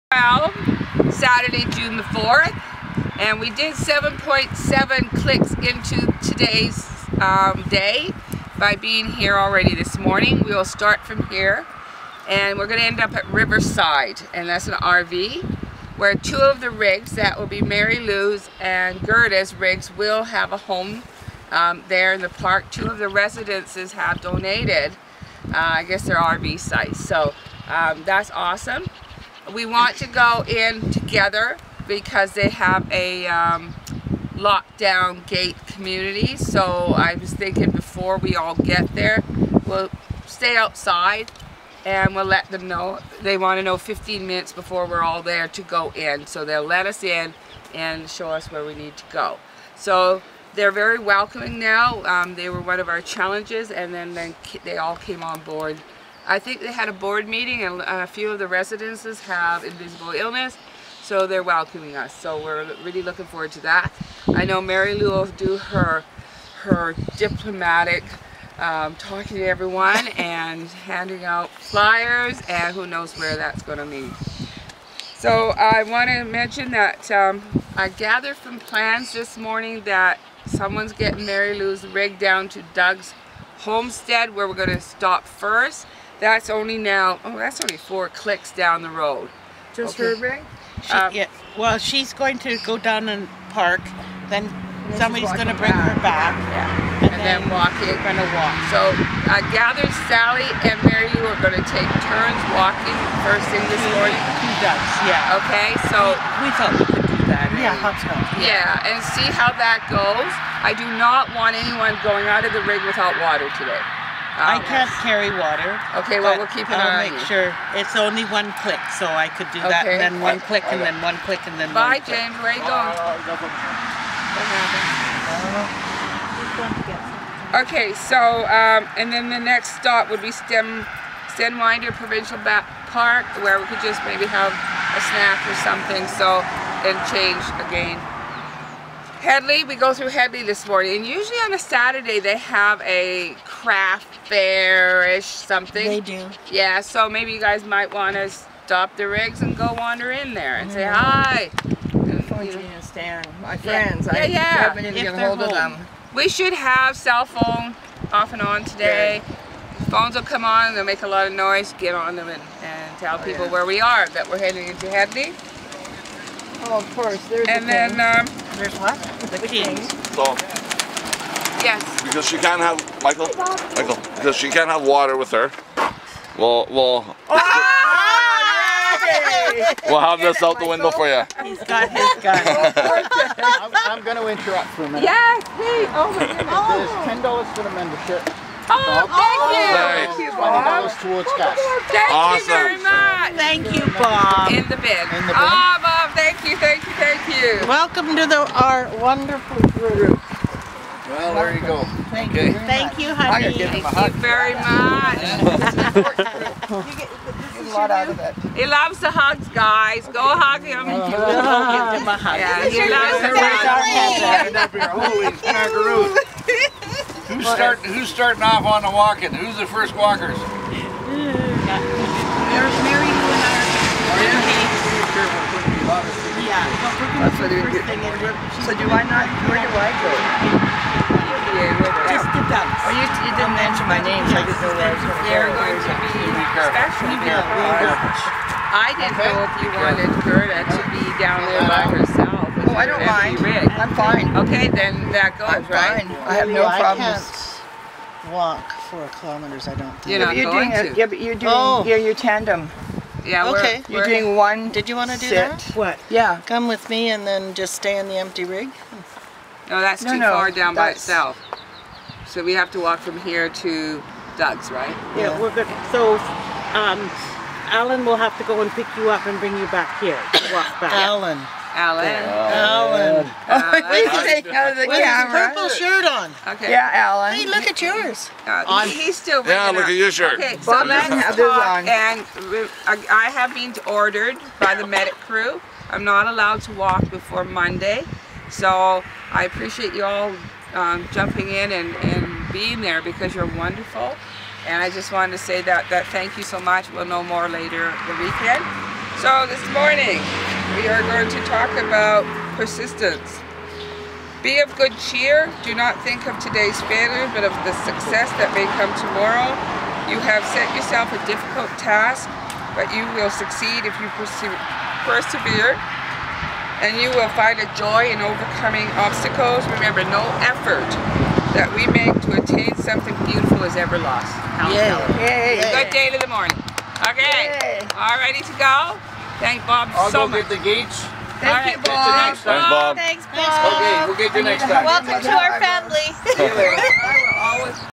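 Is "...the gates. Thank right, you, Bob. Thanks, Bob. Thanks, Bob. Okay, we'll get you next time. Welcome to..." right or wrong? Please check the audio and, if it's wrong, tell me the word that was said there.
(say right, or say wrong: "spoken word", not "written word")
right.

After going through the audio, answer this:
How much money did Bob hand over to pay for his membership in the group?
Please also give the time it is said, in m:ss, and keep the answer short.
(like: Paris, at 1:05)
$10, at 3:07.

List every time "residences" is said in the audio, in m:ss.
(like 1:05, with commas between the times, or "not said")
0:23, 0:58.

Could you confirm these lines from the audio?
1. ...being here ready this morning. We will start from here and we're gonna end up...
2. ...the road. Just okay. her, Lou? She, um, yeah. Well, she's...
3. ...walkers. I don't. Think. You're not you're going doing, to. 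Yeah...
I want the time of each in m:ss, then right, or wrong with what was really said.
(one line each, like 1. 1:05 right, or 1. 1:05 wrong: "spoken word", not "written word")
1. 0:08 wrong: "already", not "ready"
2. 1:28 wrong: "Ray", not "Lou"
3. 4:09 wrong: "kilometers", not "walkers".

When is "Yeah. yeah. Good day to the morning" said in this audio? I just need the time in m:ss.
5:24.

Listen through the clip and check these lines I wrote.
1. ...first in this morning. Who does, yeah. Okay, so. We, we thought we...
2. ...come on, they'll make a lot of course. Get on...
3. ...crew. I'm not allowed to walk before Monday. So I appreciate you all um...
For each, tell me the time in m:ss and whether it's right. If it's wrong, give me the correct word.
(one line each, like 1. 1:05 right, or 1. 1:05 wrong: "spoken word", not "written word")
1. 1:43 right
2. 2:40 wrong: "noise", not "course"
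3. 4:45 right.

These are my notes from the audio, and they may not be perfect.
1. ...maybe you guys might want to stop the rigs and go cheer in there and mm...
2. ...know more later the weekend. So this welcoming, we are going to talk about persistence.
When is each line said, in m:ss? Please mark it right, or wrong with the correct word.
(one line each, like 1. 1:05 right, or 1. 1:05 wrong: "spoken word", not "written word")
1. 2:27 wrong: "wander", not "cheer"
2. 4:57 wrong: "morning", not "welcoming".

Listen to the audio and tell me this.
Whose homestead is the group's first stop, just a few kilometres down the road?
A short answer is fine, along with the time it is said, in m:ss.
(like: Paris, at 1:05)
Doug's homestead, at 1:22.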